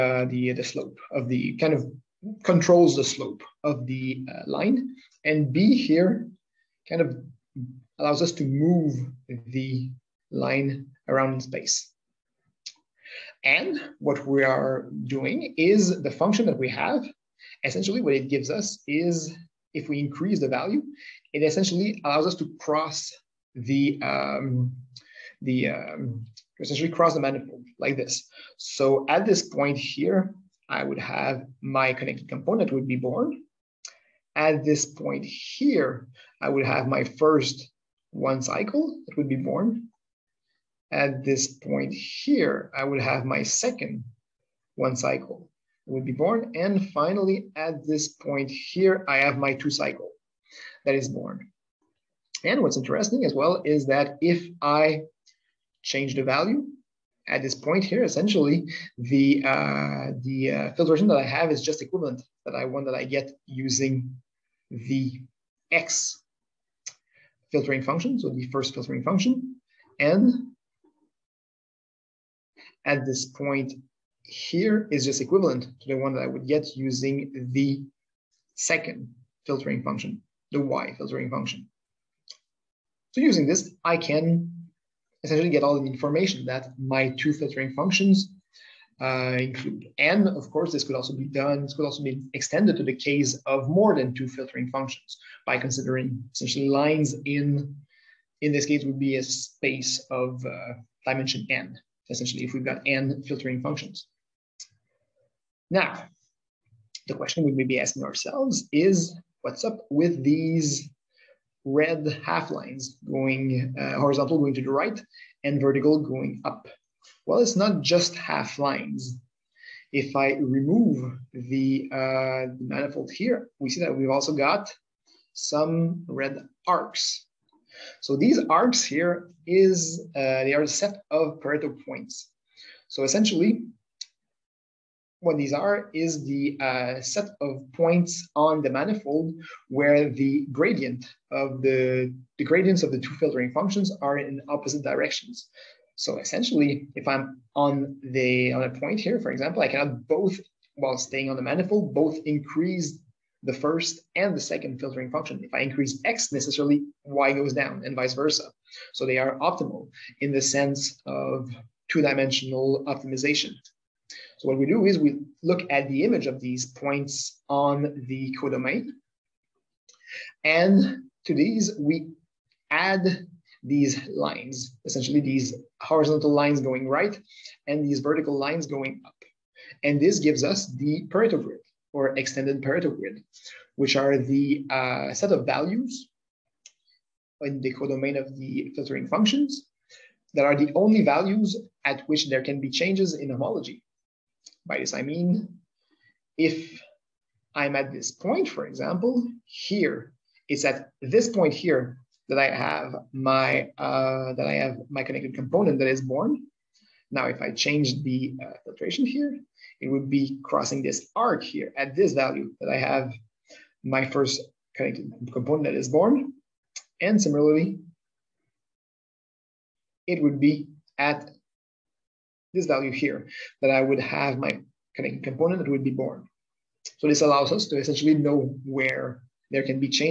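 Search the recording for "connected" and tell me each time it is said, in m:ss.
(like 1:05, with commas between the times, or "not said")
0:31, 3:25, 3:34.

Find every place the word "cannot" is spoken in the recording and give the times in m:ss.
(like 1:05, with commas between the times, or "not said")
2:29.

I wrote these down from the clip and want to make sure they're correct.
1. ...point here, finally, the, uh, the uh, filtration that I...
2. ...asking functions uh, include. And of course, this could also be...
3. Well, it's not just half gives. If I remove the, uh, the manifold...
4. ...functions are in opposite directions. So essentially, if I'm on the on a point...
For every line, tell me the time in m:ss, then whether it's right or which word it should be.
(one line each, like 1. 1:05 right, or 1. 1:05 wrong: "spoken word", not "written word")
1. 0:57 wrong: "essentially", not "finally"
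2. 1:27 wrong: "filtering", not "asking"
3. 1:57 wrong: "lines", not "gives"
4. 2:23 right.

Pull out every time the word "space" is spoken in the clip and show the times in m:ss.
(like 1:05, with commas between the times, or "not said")
0:11, 1:39.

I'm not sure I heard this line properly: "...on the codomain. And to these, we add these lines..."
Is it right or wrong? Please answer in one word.
right.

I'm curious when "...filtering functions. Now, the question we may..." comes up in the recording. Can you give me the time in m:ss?
1:43.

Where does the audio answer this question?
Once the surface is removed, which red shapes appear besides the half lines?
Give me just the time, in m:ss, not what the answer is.
2:06.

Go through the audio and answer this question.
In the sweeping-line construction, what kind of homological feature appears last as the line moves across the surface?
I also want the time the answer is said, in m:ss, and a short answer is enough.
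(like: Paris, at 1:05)
two cycle, at 0:49.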